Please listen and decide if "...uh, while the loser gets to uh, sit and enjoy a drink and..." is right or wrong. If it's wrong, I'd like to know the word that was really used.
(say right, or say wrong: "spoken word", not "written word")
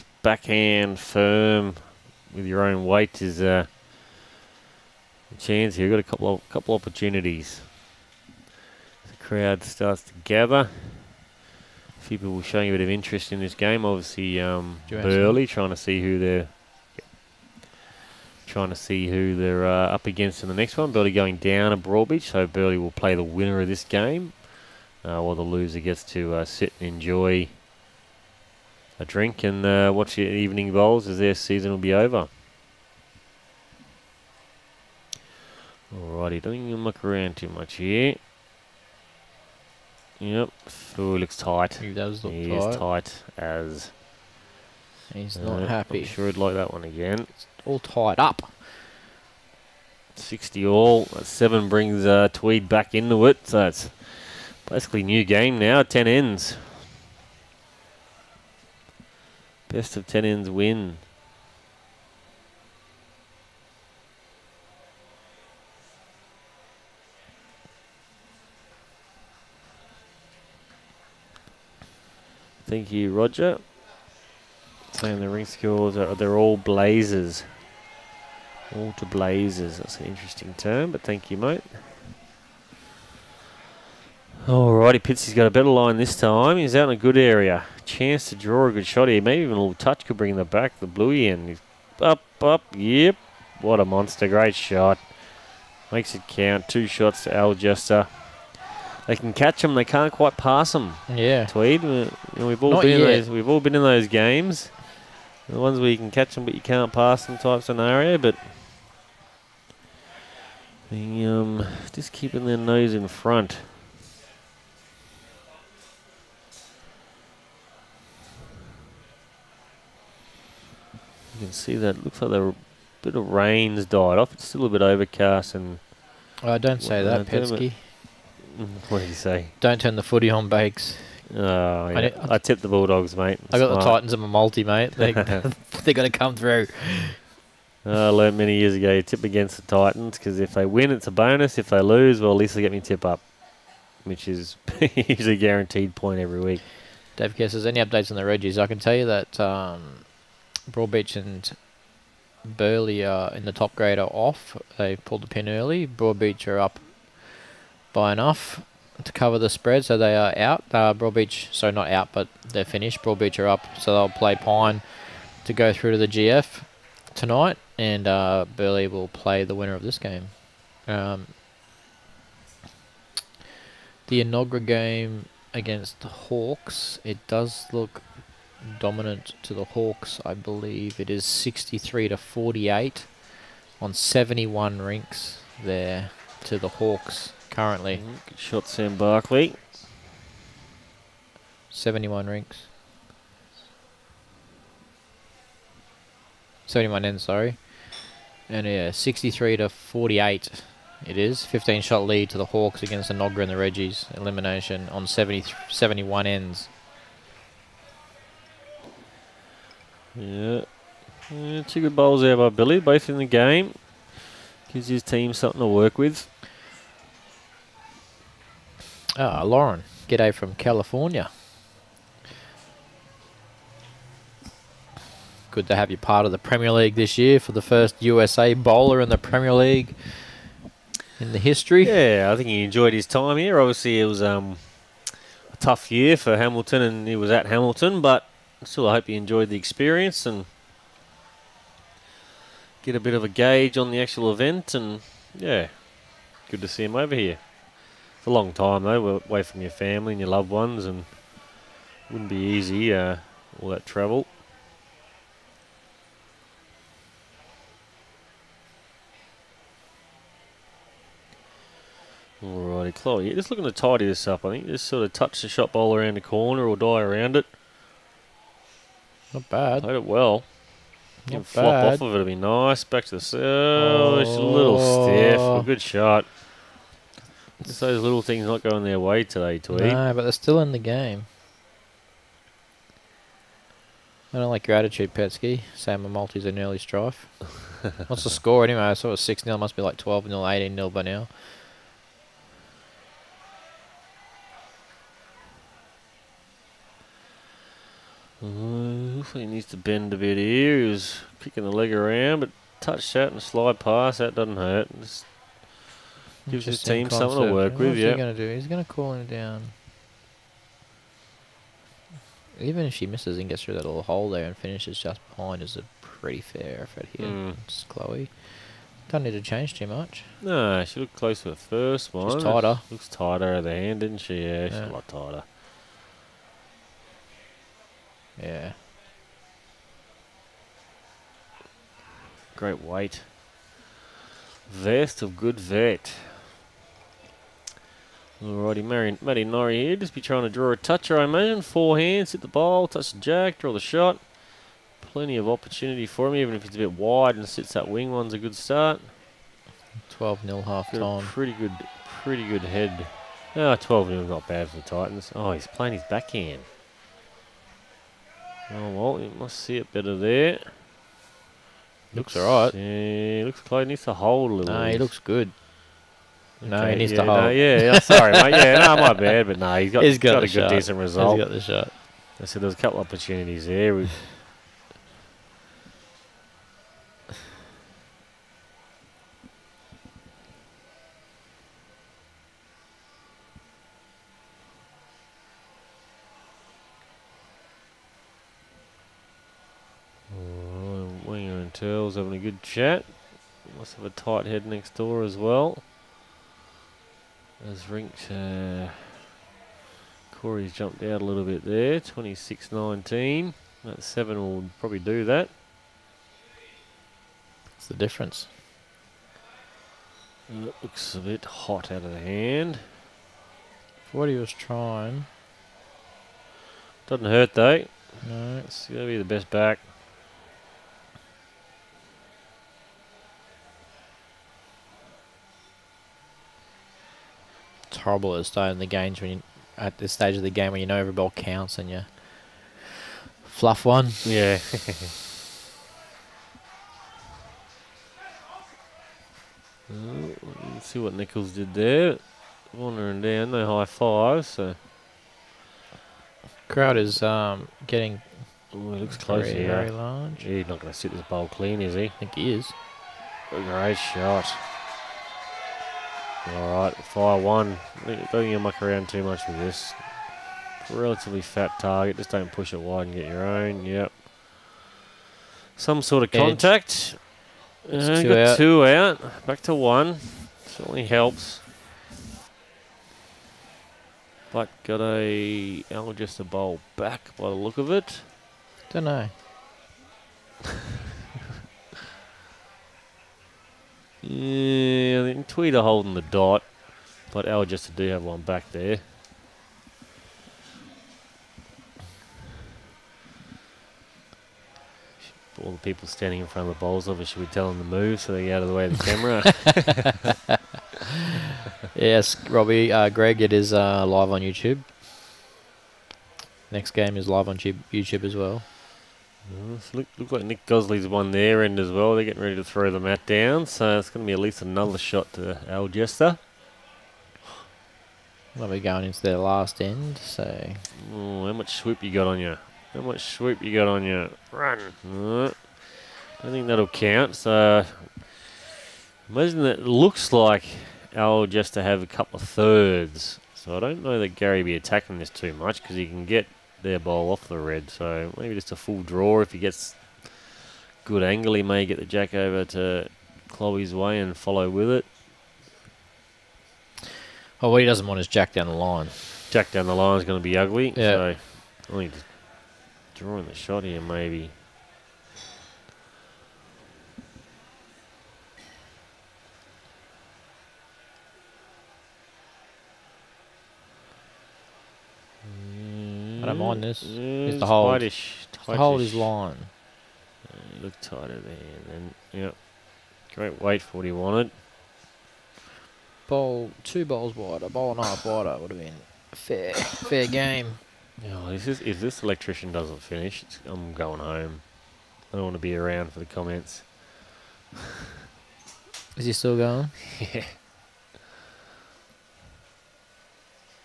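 right.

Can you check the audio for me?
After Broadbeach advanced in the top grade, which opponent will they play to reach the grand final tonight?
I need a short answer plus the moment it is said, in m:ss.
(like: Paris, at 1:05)
Pine, at 2:43.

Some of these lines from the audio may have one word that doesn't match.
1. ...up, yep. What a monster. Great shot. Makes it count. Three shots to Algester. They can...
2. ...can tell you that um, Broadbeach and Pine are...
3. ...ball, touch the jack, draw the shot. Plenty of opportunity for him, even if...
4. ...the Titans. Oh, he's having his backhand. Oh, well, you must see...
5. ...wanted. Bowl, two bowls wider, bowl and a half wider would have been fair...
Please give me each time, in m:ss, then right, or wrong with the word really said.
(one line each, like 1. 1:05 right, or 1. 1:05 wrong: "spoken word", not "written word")
1. 1:32 wrong: "Two", not "Three"
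2. 2:28 wrong: "Burleigh", not "Pine"
3. 5:42 right
4. 5:54 wrong: "playing", not "having"
5. 9:34 right.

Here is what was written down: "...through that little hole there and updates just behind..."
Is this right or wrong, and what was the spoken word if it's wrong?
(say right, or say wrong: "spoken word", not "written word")
wrong: "finishes", not "updates".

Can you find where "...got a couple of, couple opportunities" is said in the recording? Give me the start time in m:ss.
0:05.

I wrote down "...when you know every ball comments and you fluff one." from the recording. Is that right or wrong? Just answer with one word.
wrong.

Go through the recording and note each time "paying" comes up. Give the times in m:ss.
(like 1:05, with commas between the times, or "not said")
not said.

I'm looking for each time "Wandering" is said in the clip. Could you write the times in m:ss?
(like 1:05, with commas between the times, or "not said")
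7:22.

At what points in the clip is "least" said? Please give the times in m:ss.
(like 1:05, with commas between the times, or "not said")
2:22, 8:34.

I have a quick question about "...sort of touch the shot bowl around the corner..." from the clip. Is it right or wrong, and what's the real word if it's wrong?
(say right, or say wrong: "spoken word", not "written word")
right.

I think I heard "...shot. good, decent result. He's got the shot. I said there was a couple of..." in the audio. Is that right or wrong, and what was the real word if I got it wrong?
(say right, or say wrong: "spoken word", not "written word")
right.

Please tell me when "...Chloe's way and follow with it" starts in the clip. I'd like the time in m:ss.
9:03.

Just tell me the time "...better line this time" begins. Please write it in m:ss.
1:25.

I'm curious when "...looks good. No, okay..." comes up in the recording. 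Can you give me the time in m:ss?
6:04.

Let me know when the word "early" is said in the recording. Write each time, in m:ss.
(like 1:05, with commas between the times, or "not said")
2:35, 4:46.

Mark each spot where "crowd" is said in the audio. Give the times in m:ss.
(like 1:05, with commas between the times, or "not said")
0:09, 7:26.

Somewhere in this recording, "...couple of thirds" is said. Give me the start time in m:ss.
8:52.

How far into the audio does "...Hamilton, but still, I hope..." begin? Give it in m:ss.
3:57.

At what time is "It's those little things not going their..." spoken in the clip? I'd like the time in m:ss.
4:37.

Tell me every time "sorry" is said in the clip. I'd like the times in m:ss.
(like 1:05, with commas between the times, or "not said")
3:17, 6:07.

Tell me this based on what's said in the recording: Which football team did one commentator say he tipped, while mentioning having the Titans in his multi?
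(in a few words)
Bulldogs.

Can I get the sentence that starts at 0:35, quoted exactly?
Alrighty, don't even look around too much here.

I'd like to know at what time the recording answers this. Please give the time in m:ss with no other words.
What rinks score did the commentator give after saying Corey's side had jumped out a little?
6:42.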